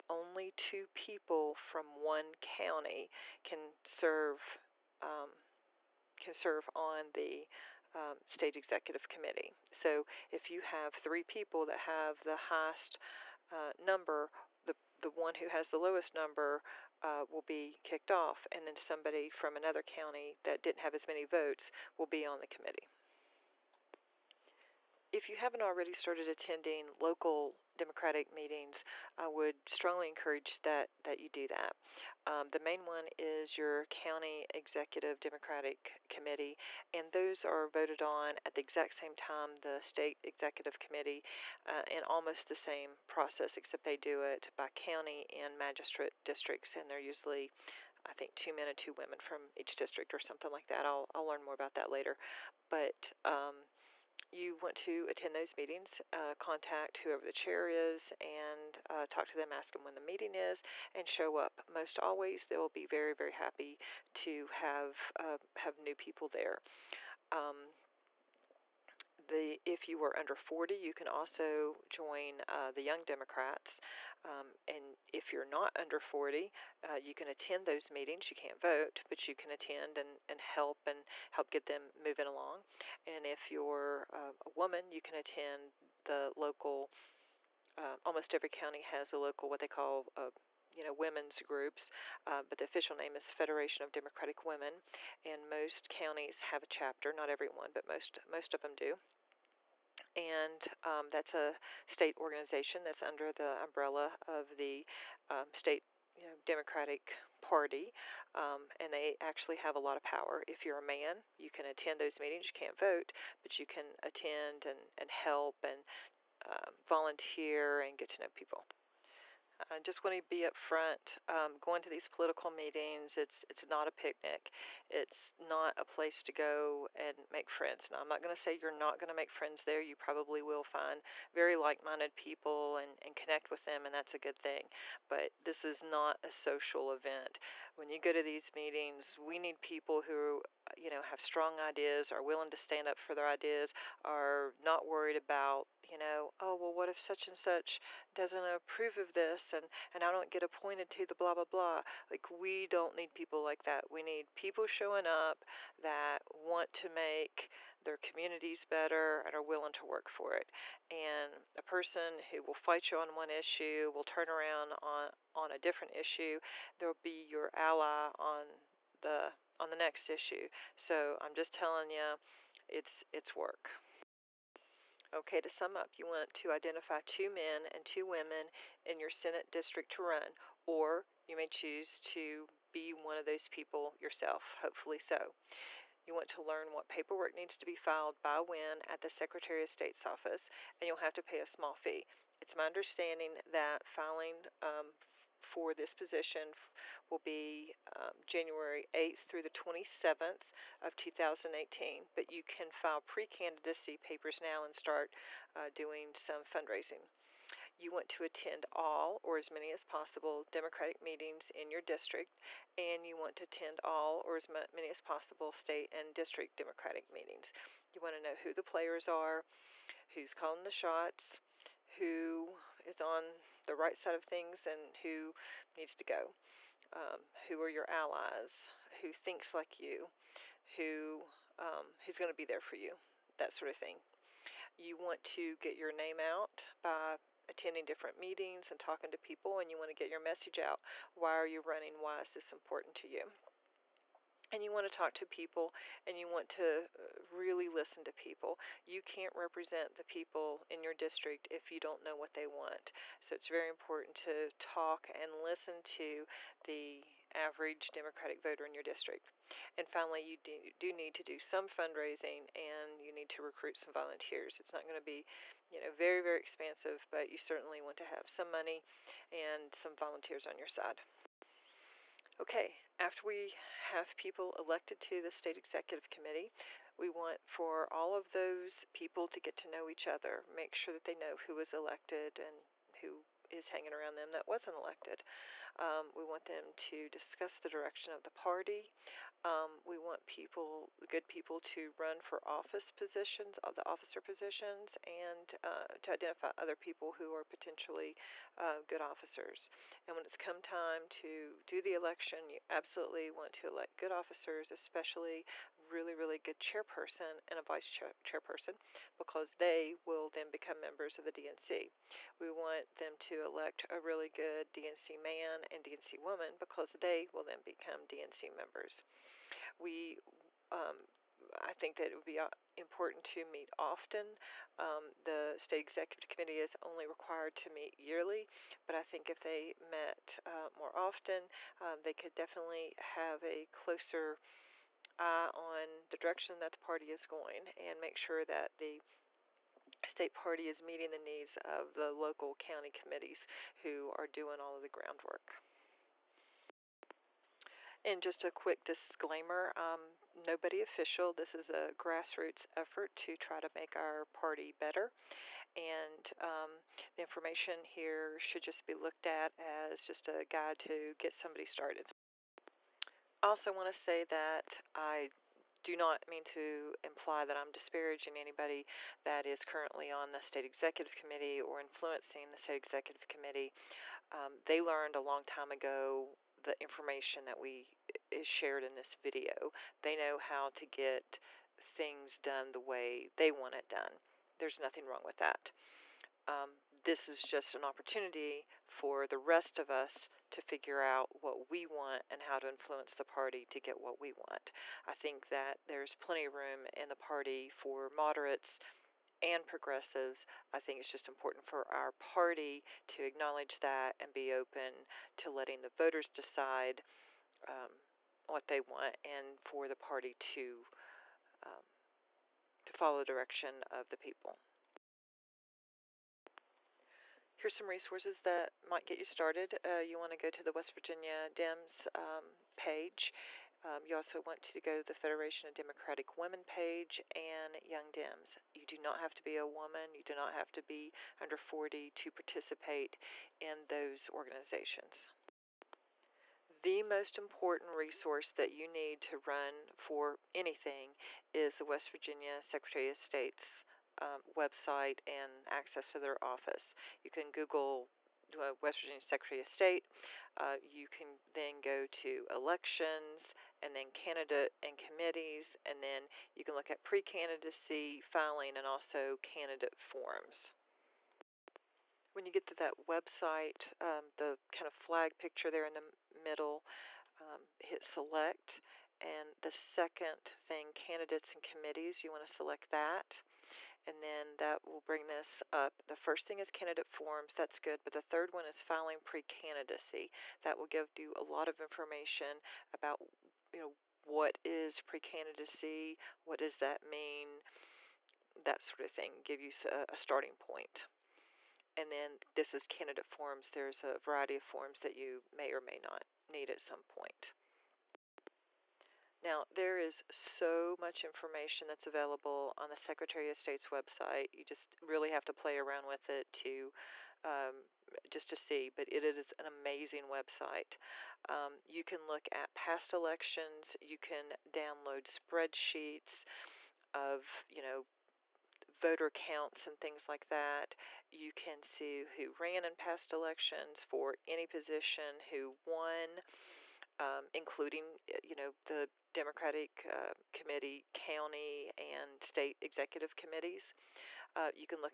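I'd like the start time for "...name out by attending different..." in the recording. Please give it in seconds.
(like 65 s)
235 s.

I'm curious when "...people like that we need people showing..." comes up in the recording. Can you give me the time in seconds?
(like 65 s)
153 s.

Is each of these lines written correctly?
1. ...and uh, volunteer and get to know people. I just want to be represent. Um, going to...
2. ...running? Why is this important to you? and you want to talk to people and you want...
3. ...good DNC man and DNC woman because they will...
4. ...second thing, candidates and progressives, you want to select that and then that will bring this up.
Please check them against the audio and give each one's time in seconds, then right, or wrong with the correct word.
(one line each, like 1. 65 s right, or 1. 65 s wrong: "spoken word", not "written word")
1. 115 s wrong: "upfront", not "represent"
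2. 241 s right
3. 314 s right
4. 469 s wrong: "committees", not "progressives".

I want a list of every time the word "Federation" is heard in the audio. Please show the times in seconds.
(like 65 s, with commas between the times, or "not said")
93 s, 425 s.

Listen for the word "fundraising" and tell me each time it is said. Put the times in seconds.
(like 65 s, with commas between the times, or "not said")
206 s, 261 s.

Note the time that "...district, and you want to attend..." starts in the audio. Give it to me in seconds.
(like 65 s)
211 s.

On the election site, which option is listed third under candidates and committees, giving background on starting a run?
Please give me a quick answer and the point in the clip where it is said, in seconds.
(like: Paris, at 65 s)
Filing pre-candidacy, at 478 s.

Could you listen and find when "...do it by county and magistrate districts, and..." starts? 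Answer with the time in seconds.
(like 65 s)
43 s.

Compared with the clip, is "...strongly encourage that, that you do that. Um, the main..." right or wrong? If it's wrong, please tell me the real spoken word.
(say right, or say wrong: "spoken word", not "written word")
right.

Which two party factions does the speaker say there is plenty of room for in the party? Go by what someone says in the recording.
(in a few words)
Moderates and progressives.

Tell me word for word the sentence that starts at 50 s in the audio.
I'll, I'll learn more about that later.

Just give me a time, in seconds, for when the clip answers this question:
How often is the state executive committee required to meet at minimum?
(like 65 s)
327 s.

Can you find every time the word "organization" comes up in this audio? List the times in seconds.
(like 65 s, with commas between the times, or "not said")
102 s, 434 s.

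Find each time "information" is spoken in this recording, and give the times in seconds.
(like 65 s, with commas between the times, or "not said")
357 s, 376 s, 481 s, 501 s.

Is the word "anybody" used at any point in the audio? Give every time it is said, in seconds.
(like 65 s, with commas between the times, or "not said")
368 s.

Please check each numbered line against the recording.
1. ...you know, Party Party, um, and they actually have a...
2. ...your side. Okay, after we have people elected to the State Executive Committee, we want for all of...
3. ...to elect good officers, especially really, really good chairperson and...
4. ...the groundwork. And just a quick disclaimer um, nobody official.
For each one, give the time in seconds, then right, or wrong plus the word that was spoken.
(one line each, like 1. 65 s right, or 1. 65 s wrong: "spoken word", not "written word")
1. 106 s wrong: "Democratic", not "Party"
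2. 270 s right
3. 303 s right
4. 344 s right.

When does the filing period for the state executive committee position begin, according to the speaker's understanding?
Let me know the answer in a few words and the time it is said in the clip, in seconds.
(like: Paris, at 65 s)
January 8, at 198 s.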